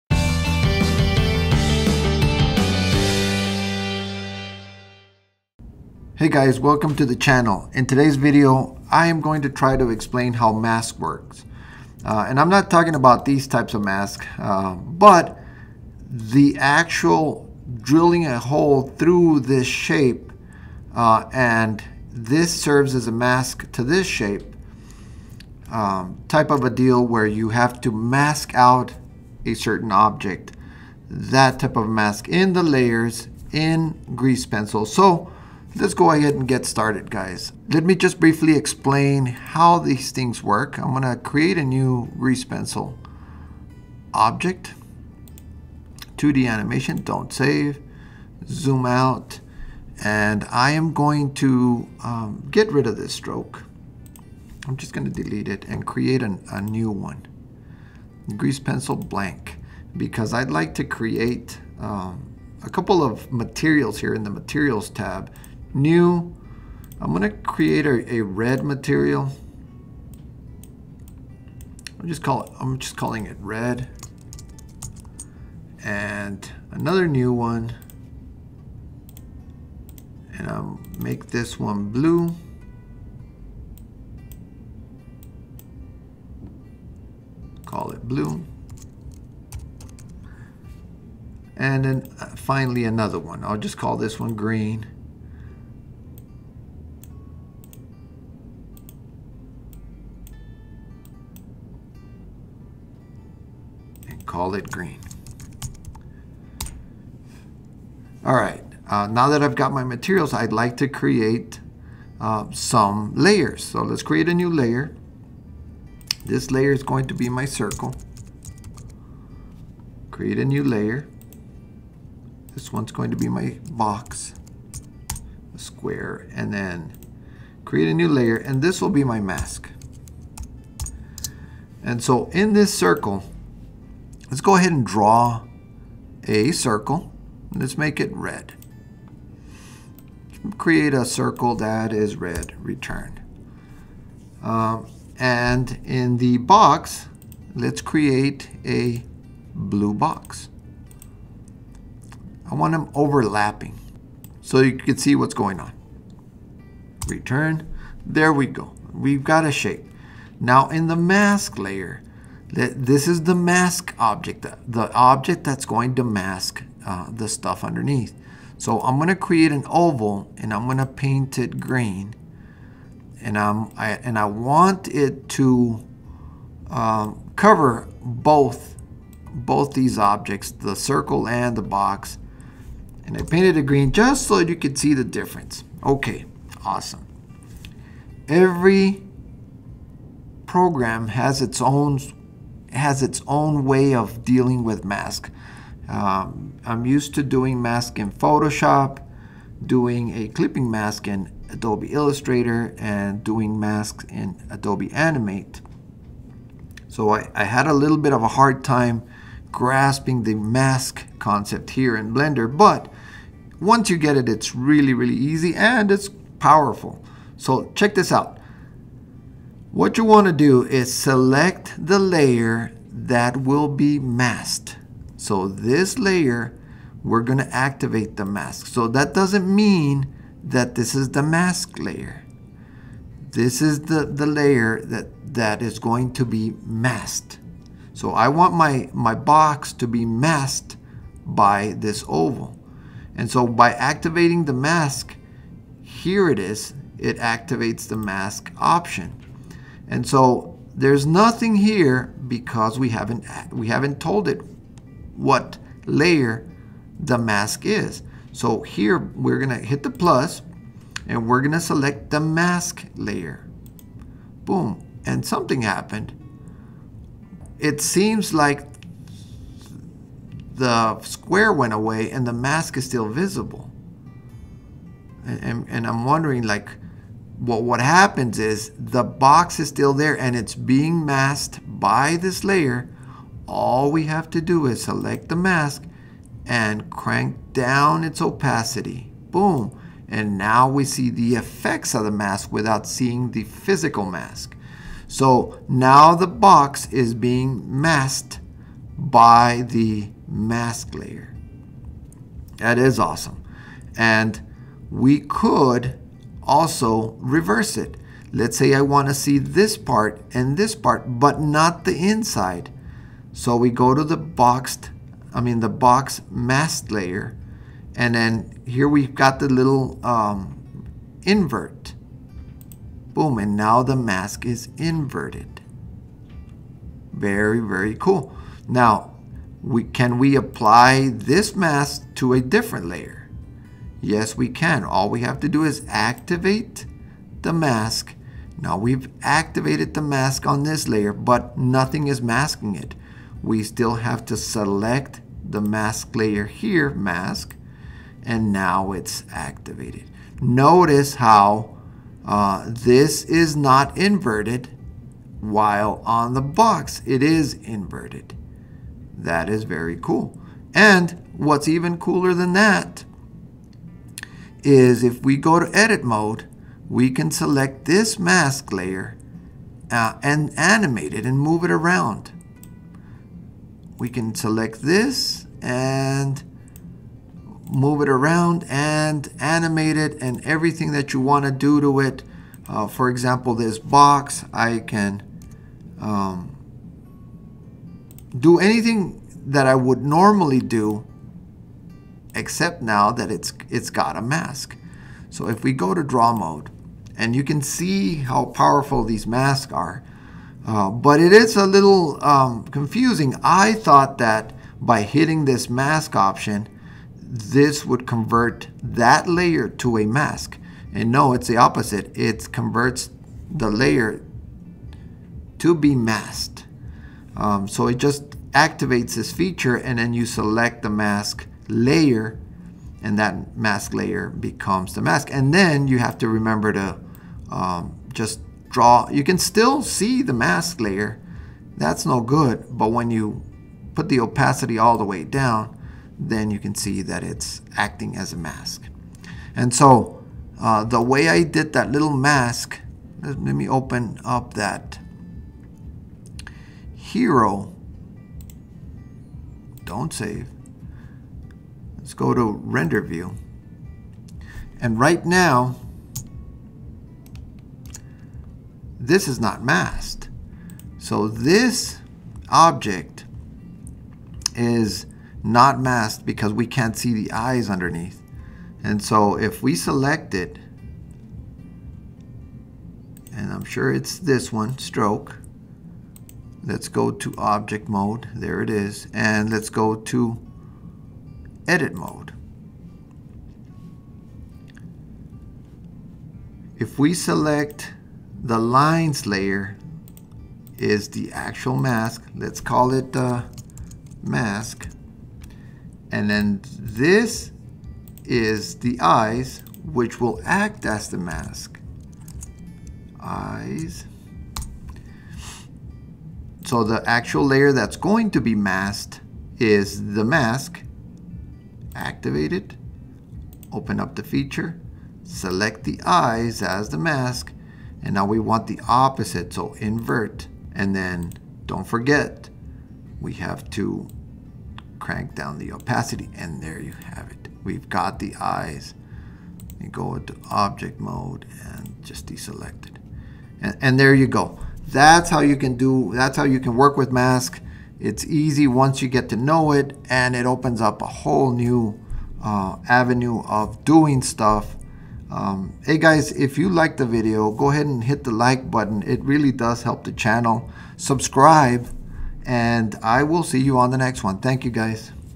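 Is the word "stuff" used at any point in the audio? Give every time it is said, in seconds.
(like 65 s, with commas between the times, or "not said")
167 s, 544 s.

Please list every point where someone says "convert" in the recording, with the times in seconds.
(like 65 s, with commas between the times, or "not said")
408 s, 412 s.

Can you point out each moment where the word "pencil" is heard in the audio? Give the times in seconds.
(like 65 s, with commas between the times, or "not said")
34 s, 42 s, 58 s.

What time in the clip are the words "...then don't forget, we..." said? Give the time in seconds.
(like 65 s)
520 s.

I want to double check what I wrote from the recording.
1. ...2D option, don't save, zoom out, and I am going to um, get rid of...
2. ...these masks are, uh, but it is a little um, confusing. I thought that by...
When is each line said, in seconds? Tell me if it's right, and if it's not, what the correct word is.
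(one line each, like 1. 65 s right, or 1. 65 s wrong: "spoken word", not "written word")
1. 46 s wrong: "animation", not "option"
2. 399 s right.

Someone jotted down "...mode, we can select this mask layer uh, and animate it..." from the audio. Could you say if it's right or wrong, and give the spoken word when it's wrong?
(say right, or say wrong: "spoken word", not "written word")
right.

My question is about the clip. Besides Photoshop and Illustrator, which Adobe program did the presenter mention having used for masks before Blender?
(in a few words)
Adobe Animate.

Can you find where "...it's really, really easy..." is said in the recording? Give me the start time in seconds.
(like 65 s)
214 s.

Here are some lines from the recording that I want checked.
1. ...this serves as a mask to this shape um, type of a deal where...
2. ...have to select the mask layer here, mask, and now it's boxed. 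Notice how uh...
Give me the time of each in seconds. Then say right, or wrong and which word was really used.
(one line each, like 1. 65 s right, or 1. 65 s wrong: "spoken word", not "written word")
1. 22 s right
2. 343 s wrong: "activated", not "boxed".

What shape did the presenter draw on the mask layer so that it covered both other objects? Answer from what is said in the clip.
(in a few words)
an oval.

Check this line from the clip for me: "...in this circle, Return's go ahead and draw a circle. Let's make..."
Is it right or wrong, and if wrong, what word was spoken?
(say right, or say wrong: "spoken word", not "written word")
wrong: "Let", not "Return".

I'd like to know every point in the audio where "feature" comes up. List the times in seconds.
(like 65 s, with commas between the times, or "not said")
419 s, 514 s.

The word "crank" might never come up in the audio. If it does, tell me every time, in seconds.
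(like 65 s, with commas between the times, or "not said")
286 s, 524 s.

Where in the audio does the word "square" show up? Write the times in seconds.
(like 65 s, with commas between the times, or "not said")
125 s, 271 s.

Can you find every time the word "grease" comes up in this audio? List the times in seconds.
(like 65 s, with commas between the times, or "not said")
34 s, 42 s, 58 s.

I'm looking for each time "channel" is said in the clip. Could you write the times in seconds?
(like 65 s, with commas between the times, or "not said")
7 s, 550 s.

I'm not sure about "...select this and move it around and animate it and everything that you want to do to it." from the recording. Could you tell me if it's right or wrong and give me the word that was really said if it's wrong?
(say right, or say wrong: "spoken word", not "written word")
right.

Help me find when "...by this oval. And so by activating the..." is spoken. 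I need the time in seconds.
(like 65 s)
241 s.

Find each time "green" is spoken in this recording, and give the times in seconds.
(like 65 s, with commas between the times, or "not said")
94 s, 104 s, 171 s, 183 s.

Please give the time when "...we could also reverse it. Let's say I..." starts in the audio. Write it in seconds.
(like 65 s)
304 s.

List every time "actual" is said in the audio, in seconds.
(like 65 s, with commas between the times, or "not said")
16 s, 491 s, 507 s.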